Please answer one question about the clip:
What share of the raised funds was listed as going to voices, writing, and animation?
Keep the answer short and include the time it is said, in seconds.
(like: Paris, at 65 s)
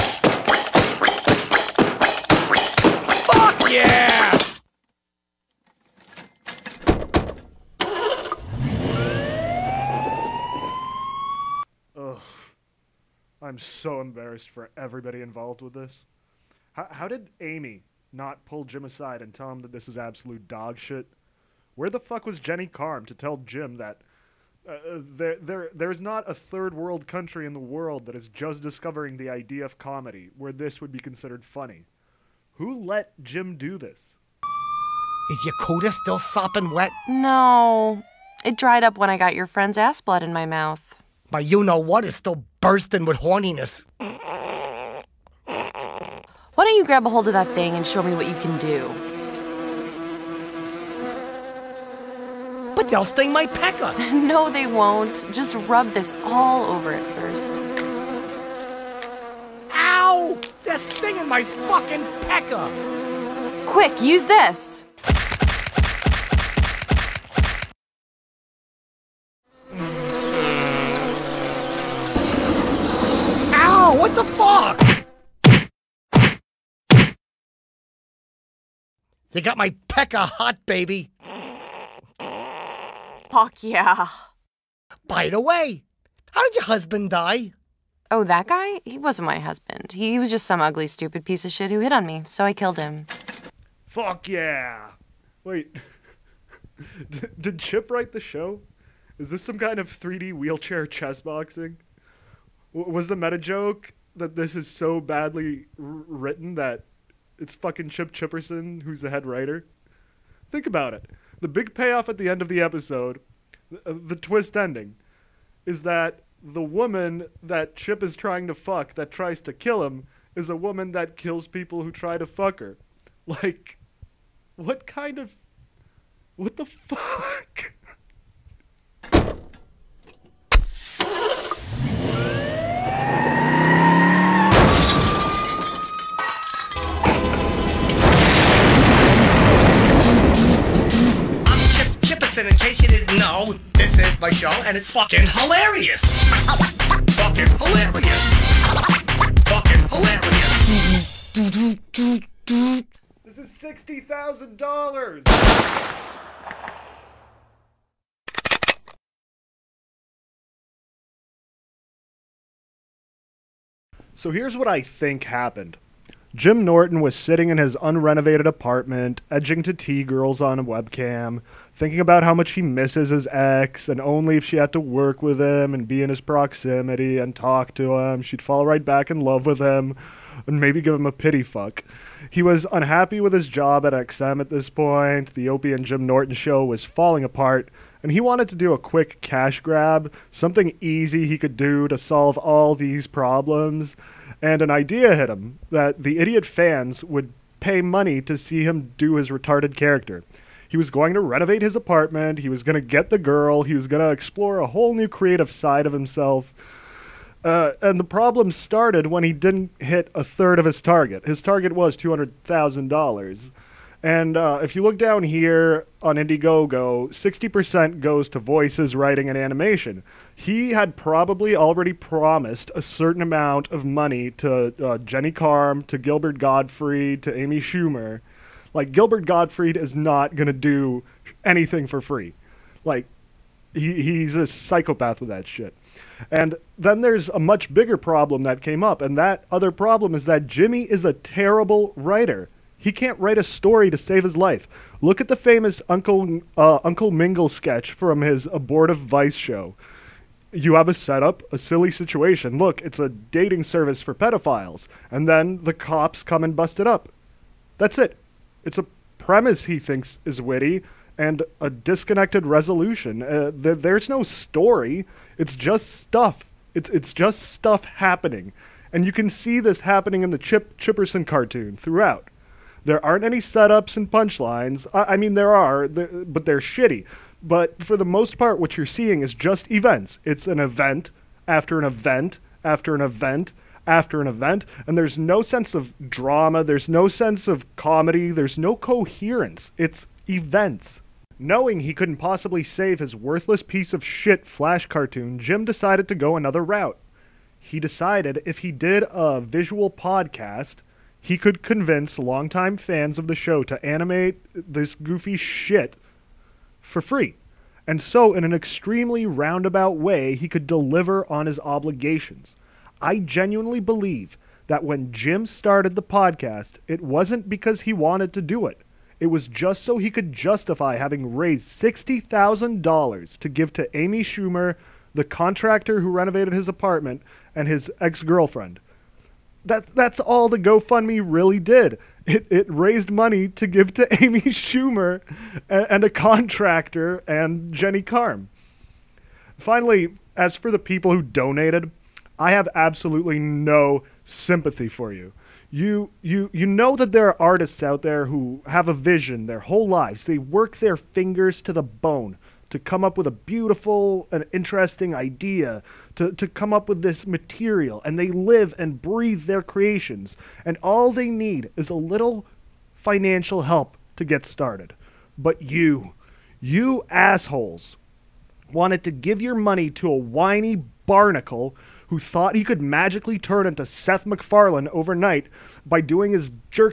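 60%, at 217 s.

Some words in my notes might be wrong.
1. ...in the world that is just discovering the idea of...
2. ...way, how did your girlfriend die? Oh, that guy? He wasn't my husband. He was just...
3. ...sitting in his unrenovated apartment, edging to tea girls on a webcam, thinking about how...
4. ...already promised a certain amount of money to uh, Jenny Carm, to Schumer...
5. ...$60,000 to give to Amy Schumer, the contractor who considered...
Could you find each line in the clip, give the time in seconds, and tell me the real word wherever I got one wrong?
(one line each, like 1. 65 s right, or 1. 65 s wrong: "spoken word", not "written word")
1. 27 s right
2. 85 s wrong: "husband", not "girlfriend"
3. 167 s right
4. 221 s wrong: "Gilbert", not "Schumer"
5. 321 s wrong: "renovated", not "considered".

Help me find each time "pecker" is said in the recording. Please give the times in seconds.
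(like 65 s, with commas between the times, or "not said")
53 s, 62 s, 79 s.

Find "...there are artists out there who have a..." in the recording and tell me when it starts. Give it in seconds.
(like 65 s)
347 s.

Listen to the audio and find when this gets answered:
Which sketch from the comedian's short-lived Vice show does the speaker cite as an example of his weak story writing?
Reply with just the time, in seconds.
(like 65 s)
246 s.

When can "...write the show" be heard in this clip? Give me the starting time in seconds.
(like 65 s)
97 s.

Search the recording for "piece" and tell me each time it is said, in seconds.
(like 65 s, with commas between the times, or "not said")
91 s, 293 s.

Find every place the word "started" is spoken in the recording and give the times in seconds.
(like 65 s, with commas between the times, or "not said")
208 s, 315 s, 364 s.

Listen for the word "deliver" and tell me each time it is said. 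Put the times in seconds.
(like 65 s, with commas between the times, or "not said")
310 s.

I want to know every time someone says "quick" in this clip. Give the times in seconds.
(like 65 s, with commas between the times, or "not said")
63 s, 188 s.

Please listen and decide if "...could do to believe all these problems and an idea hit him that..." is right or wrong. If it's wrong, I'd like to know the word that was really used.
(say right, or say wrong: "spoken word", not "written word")
wrong: "solve", not "believe".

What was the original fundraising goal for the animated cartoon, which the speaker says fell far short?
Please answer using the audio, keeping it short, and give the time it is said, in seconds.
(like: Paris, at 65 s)
$200,000, at 211 s.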